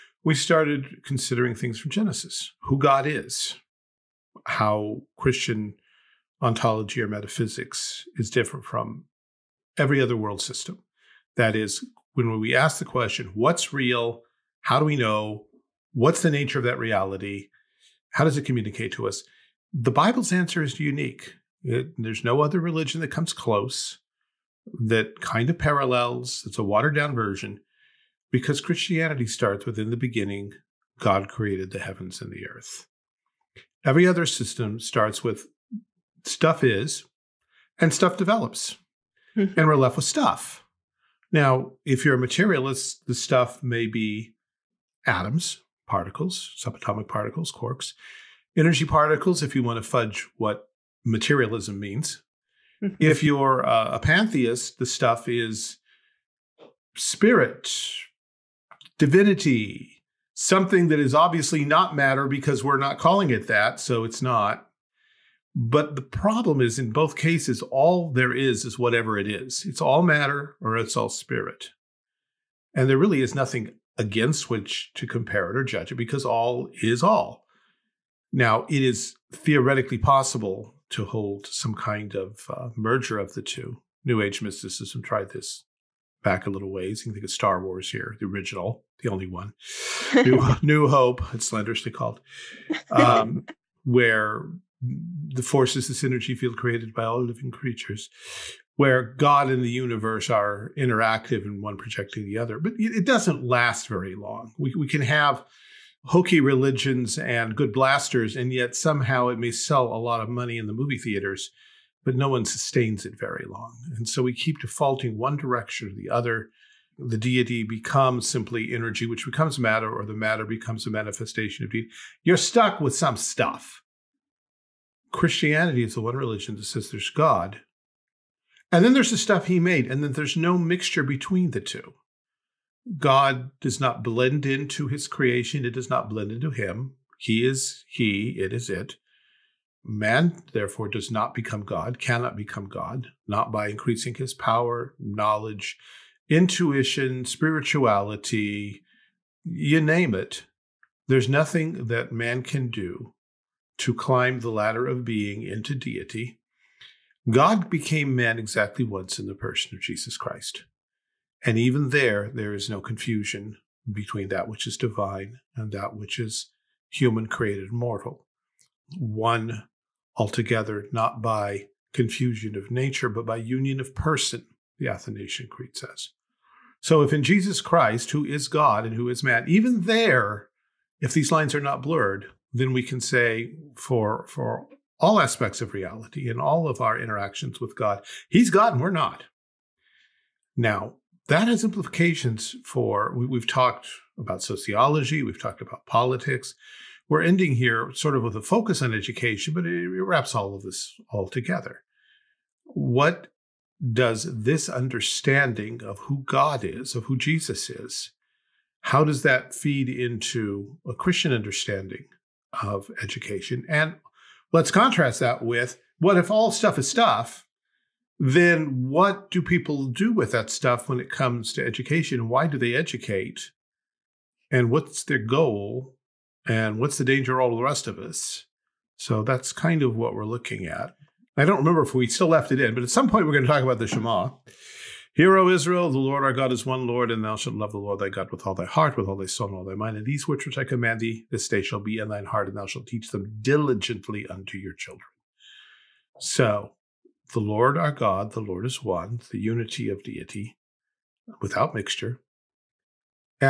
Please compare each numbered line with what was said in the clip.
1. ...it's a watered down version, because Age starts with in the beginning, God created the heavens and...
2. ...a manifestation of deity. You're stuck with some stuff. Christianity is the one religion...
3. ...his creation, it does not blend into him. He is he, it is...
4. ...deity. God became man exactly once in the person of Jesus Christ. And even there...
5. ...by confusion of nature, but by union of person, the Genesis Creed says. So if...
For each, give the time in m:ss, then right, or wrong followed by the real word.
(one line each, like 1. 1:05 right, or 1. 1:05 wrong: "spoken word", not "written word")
1. 0:26 wrong: "Christianity", not "Age"
2. 2:00 right
3. 2:14 right
4. 2:35 right
5. 2:51 wrong: "Athanasian", not "Genesis".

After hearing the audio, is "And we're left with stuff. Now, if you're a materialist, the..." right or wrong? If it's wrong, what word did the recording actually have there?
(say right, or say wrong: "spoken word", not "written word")
right.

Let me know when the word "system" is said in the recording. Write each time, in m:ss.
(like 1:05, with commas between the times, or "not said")
0:10, 0:34.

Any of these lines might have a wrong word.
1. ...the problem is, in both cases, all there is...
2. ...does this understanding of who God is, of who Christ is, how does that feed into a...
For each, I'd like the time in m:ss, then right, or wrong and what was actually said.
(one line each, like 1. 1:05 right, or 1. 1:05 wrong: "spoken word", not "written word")
1. 1:05 right
2. 3:23 wrong: "Jesus", not "Christ".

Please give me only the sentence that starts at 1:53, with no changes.
And so we keep defaulting one direction or the other.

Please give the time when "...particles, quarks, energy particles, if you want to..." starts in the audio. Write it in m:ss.
0:47.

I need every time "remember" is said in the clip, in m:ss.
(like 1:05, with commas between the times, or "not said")
3:51.